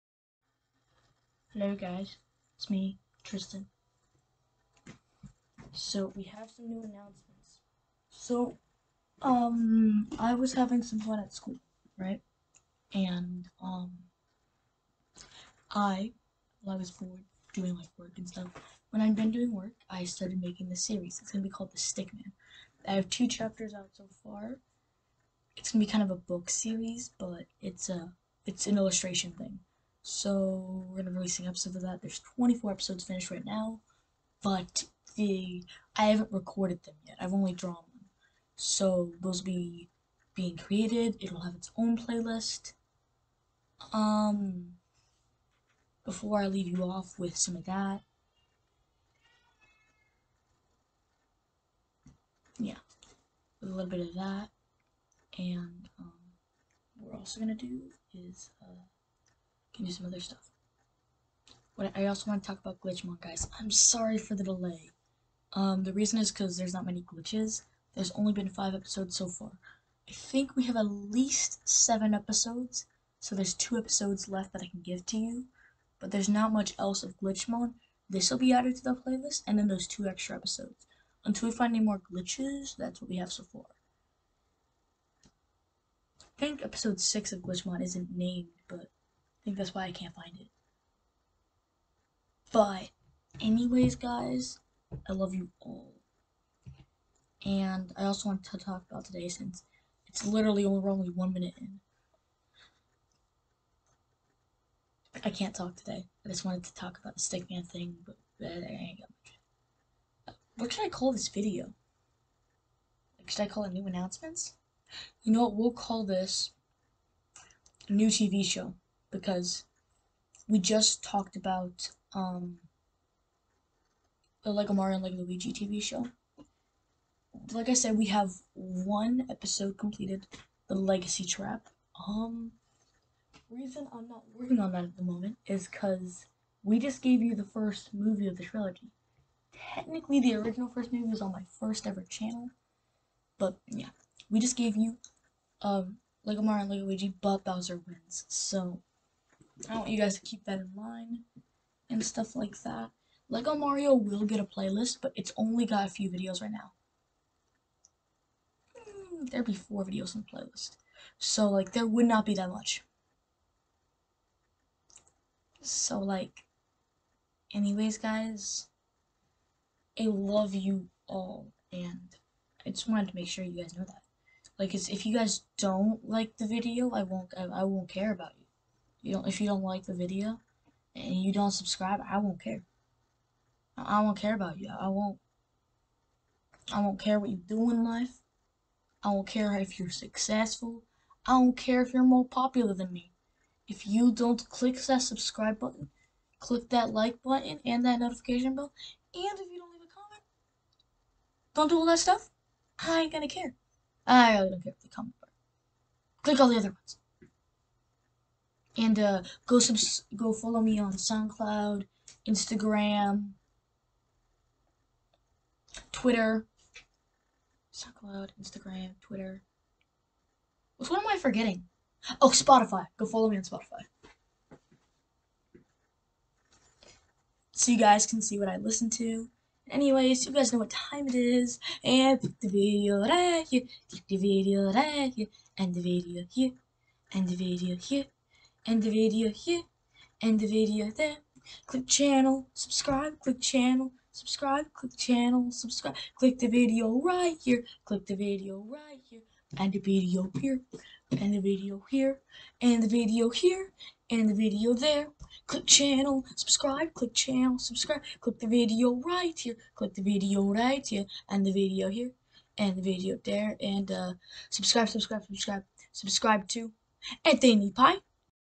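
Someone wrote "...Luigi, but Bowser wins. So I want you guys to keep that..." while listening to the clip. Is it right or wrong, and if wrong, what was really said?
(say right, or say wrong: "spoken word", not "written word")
right.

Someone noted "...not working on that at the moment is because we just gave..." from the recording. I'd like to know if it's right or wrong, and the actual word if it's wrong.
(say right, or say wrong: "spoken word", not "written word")
right.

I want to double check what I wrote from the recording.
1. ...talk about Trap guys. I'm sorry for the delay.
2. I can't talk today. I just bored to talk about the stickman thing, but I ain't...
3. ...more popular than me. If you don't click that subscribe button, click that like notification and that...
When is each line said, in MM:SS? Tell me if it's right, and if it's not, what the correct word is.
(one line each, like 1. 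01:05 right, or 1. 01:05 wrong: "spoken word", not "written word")
1. 01:02 wrong: "Glitchmon", not "Trap"
2. 01:45 wrong: "wanted", not "bored"
3. 03:12 wrong: "button", not "notification".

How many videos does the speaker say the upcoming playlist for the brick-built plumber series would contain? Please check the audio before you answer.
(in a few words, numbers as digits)
4.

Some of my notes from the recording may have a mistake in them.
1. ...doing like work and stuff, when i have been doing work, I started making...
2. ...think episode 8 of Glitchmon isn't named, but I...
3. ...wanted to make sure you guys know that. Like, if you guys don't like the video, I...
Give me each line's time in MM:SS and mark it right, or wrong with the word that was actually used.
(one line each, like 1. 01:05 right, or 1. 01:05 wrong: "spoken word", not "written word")
1. 00:17 right
2. 01:26 wrong: "6", not "8"
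3. 02:52 right.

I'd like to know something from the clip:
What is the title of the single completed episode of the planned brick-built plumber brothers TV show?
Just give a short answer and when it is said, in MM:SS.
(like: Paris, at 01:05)
The Legacy Trap, at 02:10.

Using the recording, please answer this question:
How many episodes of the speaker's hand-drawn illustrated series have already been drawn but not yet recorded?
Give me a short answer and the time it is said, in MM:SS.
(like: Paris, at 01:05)
24, at 00:32.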